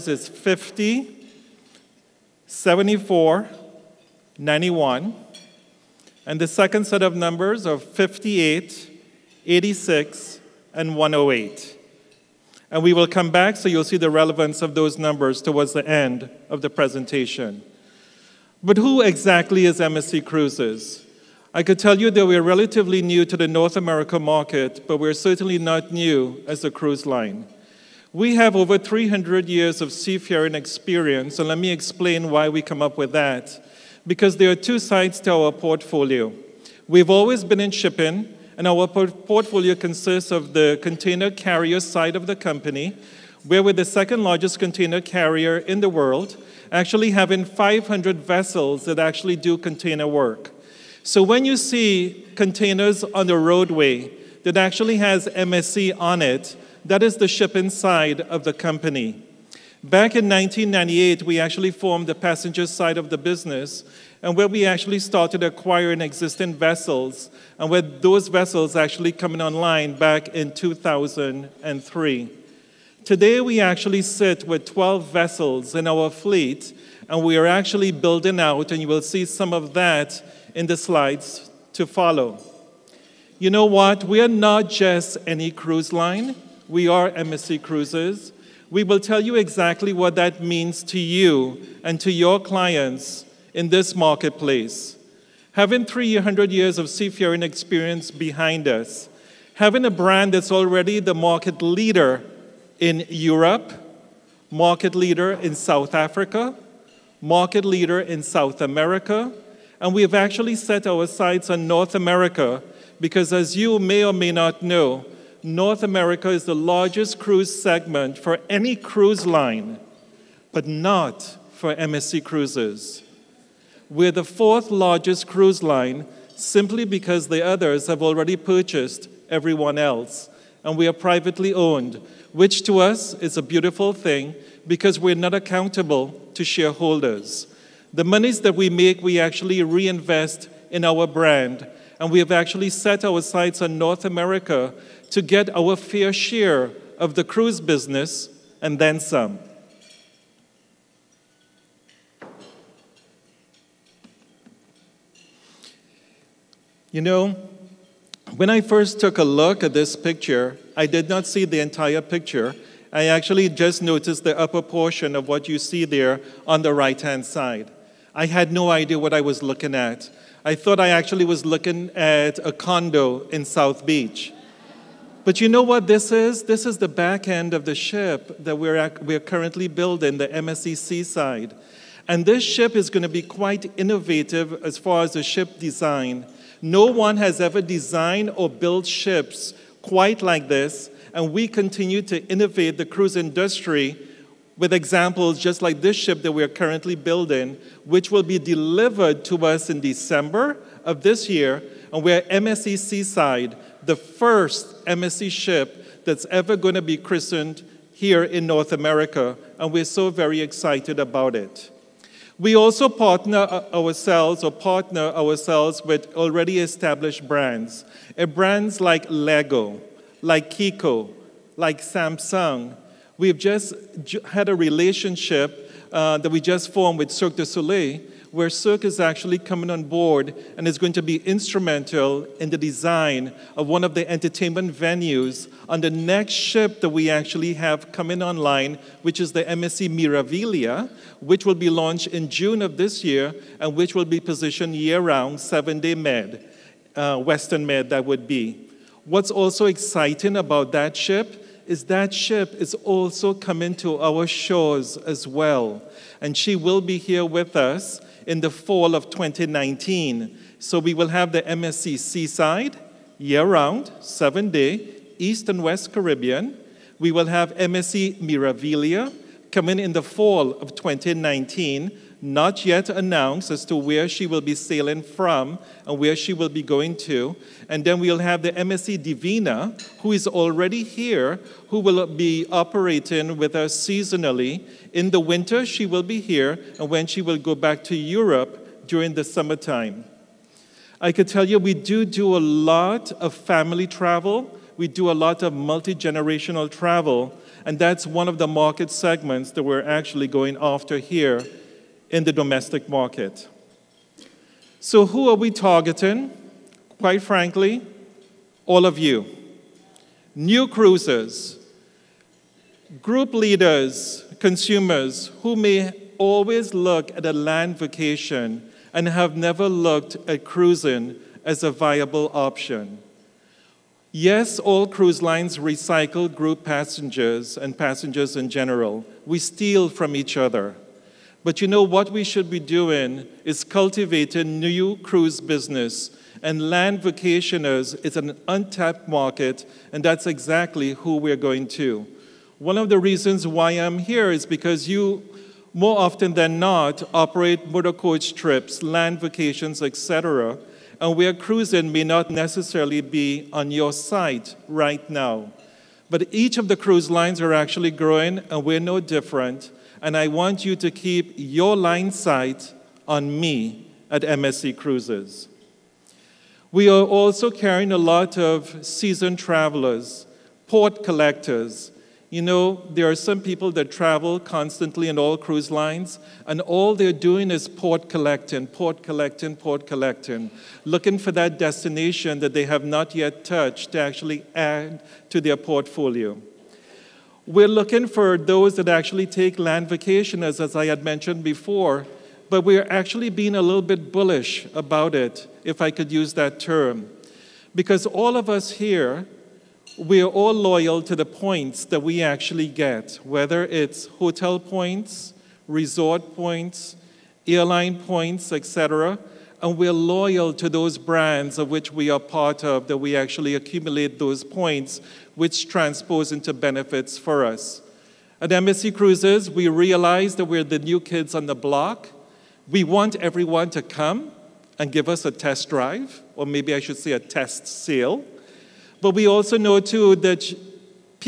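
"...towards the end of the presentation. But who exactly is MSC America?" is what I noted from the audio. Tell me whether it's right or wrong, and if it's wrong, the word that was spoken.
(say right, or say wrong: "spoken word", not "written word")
wrong: "Cruises", not "America".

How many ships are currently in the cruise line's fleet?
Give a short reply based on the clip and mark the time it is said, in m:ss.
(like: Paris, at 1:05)
12, at 1:14.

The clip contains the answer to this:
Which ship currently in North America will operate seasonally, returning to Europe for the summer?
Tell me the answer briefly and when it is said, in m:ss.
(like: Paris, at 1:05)
MSC Divina, at 4:38.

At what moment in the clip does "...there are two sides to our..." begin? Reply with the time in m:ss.
0:34.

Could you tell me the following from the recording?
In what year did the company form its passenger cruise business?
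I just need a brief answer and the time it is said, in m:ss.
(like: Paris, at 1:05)
1998, at 0:59.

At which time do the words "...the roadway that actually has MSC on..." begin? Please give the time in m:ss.
0:53.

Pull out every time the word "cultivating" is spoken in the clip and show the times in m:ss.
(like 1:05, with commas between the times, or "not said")
5:33.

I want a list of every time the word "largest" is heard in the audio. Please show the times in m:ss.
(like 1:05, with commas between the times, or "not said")
0:44, 1:56, 2:04.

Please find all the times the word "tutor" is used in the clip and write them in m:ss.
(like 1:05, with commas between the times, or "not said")
not said.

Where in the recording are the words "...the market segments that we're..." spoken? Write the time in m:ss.
4:58.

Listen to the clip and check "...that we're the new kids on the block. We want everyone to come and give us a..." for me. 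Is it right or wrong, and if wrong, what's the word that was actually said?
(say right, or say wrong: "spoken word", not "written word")
right.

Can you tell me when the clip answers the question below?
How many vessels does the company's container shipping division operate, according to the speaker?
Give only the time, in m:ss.
0:47.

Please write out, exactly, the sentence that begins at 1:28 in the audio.
We will tell you exactly what that means to you and to your clients in this marketplace.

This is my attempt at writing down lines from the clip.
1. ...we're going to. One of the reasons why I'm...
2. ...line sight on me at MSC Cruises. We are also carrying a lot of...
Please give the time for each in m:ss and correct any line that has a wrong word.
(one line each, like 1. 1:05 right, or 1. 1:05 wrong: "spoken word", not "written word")
1. 5:41 right
2. 6:01 right.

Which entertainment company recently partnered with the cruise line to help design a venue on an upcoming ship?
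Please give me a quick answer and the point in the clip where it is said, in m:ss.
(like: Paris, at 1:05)
Cirque du Soleil, at 3:47.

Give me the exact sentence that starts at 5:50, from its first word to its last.
And where cruising may not necessarily be on your site right now.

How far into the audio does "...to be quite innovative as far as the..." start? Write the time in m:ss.
3:03.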